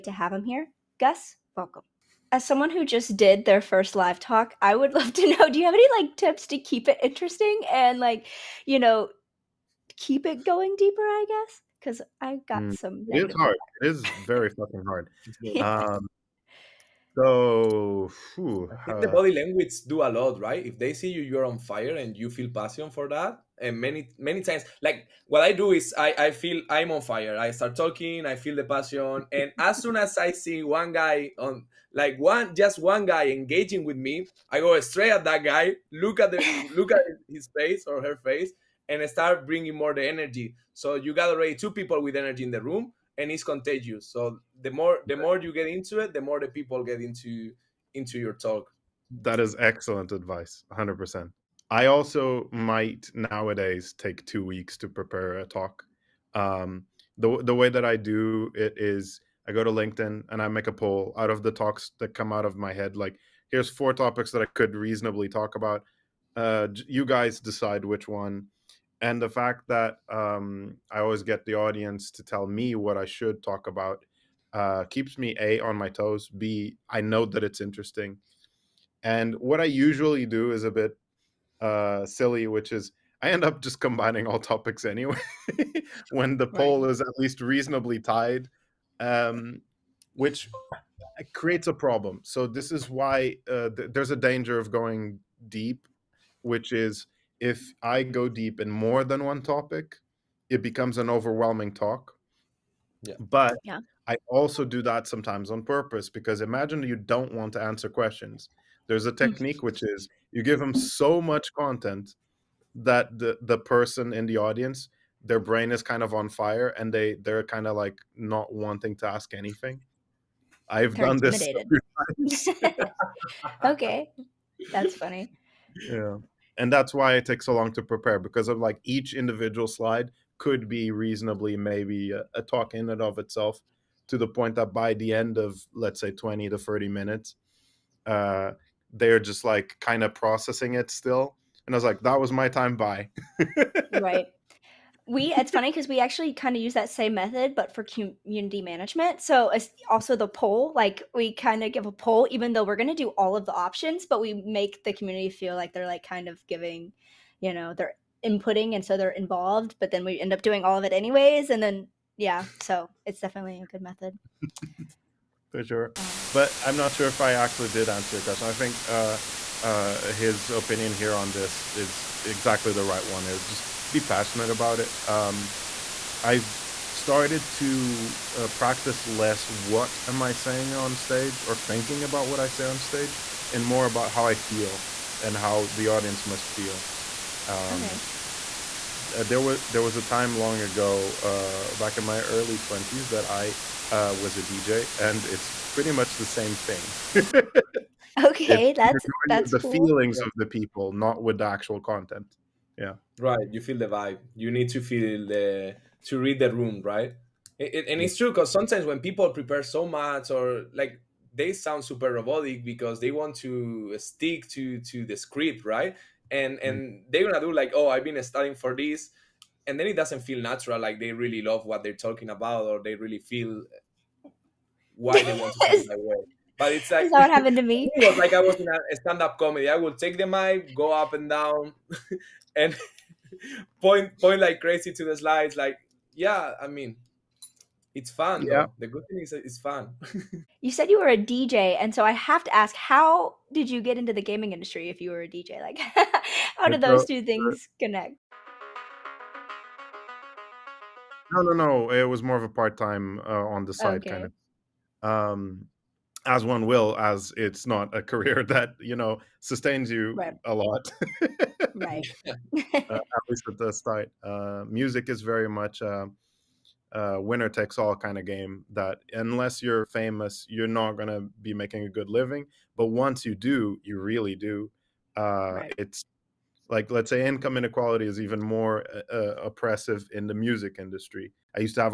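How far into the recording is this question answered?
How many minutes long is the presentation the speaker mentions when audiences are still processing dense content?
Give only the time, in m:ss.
2:16.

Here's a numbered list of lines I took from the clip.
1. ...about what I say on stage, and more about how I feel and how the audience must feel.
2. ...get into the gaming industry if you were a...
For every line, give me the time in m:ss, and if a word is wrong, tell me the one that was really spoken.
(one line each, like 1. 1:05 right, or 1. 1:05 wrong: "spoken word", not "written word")
1. 3:02 right
2. 4:03 right.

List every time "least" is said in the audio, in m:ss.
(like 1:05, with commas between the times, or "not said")
1:27, 4:23.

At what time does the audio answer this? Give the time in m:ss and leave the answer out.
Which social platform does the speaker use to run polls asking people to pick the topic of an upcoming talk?
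0:59.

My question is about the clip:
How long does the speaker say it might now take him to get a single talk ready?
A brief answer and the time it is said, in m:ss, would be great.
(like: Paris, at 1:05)
2 weeks, at 0:54.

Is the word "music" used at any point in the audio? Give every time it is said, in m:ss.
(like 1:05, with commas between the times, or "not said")
4:24, 4:40.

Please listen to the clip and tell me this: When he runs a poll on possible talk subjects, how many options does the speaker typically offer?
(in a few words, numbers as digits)
4.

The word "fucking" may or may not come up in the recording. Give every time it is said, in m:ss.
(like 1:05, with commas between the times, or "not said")
0:14.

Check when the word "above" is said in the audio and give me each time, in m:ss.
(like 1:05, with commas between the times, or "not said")
not said.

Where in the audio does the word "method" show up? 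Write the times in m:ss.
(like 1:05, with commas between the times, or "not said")
2:27, 2:43.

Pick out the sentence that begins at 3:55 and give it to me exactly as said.
Like, yeah, I mean, it's fun.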